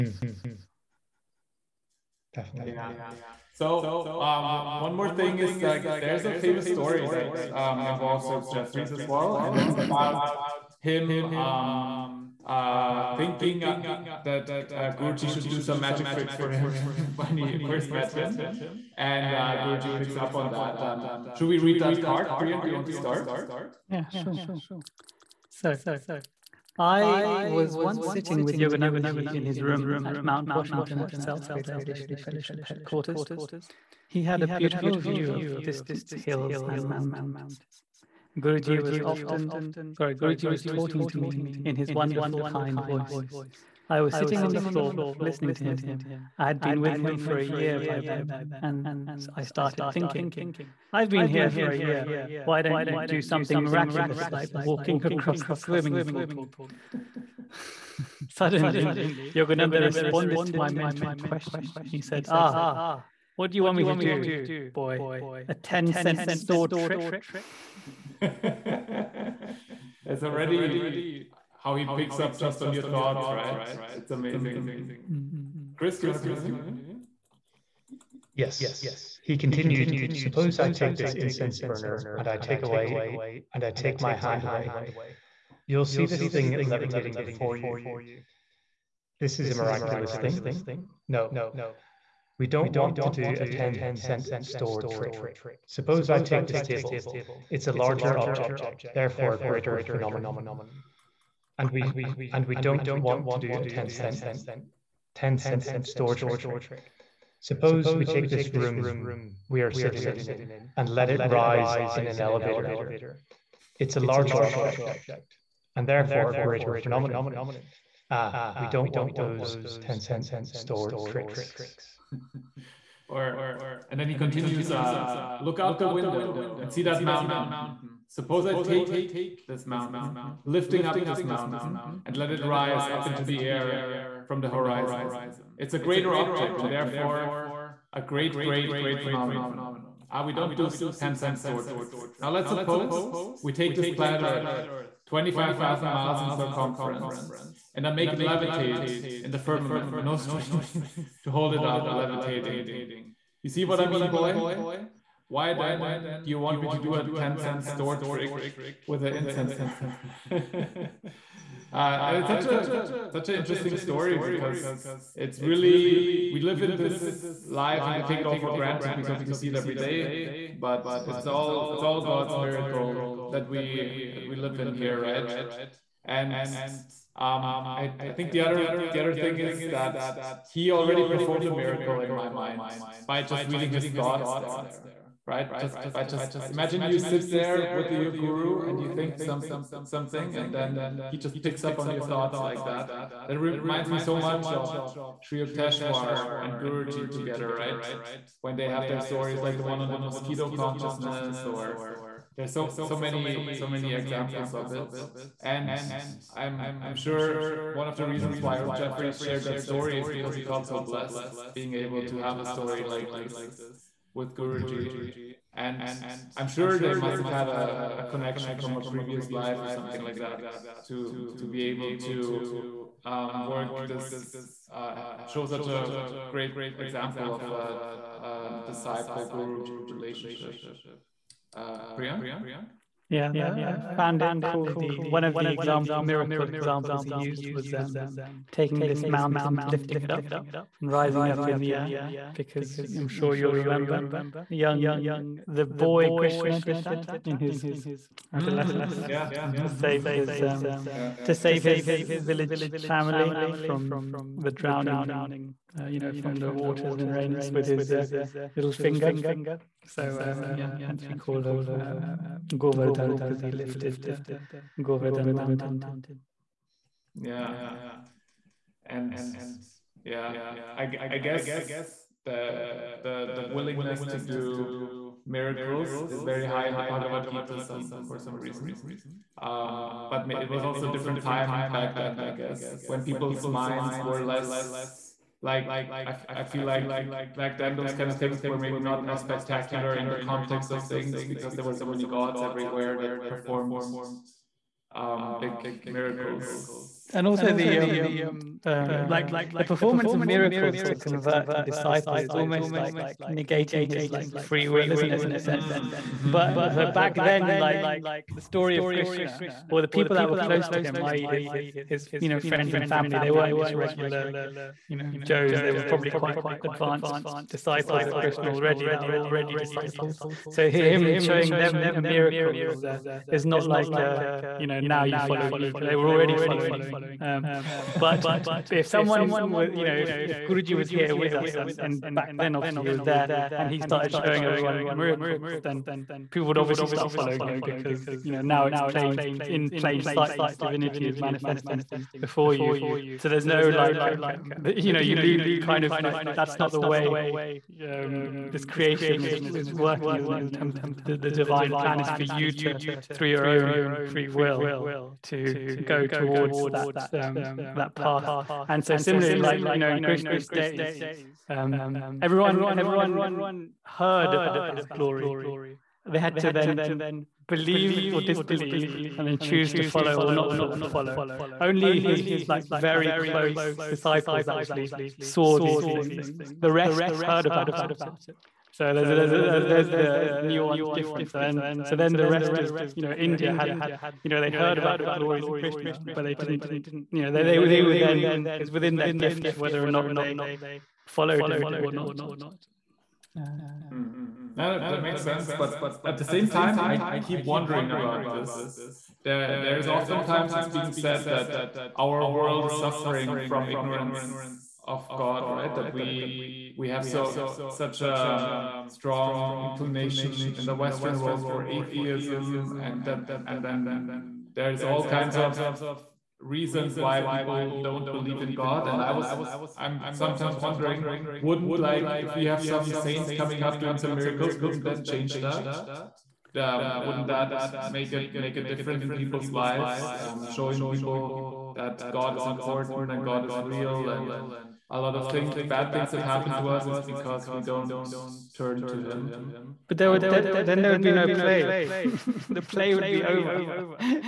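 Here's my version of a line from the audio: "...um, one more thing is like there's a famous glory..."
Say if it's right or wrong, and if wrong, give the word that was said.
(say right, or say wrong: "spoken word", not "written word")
wrong: "story", not "glory".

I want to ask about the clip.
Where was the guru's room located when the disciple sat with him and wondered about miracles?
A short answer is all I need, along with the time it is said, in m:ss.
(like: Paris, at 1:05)
Mount Washington, at 0:30.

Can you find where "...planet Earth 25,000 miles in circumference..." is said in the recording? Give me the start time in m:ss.
2:23.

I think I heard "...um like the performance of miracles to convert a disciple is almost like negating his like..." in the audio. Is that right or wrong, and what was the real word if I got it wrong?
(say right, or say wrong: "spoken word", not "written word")
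right.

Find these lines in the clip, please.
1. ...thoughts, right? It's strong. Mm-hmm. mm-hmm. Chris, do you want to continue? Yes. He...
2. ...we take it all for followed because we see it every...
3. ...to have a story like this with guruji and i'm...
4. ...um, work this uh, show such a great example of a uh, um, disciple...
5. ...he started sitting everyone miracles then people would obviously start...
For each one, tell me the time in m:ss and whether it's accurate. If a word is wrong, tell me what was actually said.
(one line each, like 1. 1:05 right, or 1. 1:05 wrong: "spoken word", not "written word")
1. 1:12 wrong: "amazing", not "strong"
2. 2:47 wrong: "granted", not "followed"
3. 3:32 right
4. 3:43 right
5. 5:33 wrong: "showing", not "sitting".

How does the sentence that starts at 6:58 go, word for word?
And I was I'm sometimes wondering, wouldn't like if we have some saints coming up doing some miracles, wouldn't that change that?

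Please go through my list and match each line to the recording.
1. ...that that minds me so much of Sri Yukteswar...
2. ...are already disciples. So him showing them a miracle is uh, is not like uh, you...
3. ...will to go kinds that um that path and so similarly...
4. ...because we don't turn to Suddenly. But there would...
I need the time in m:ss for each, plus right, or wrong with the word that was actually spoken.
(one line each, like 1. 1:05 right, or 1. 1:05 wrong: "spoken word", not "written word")
1. 3:12 wrong: "reminds", not "minds"
2. 5:19 right
3. 5:54 wrong: "towards", not "kinds"
4. 7:17 wrong: "Him", not "Suddenly".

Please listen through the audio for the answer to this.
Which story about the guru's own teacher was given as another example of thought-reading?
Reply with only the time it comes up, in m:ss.
3:20.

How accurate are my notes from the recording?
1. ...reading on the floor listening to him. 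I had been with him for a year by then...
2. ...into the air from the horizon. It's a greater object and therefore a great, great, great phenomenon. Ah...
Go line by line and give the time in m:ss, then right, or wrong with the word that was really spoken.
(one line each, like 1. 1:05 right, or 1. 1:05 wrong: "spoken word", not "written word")
1. 0:44 wrong: "sitting", not "reading"
2. 2:13 right.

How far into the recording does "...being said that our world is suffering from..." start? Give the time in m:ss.
6:40.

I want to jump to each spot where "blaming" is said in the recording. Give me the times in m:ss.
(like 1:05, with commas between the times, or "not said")
not said.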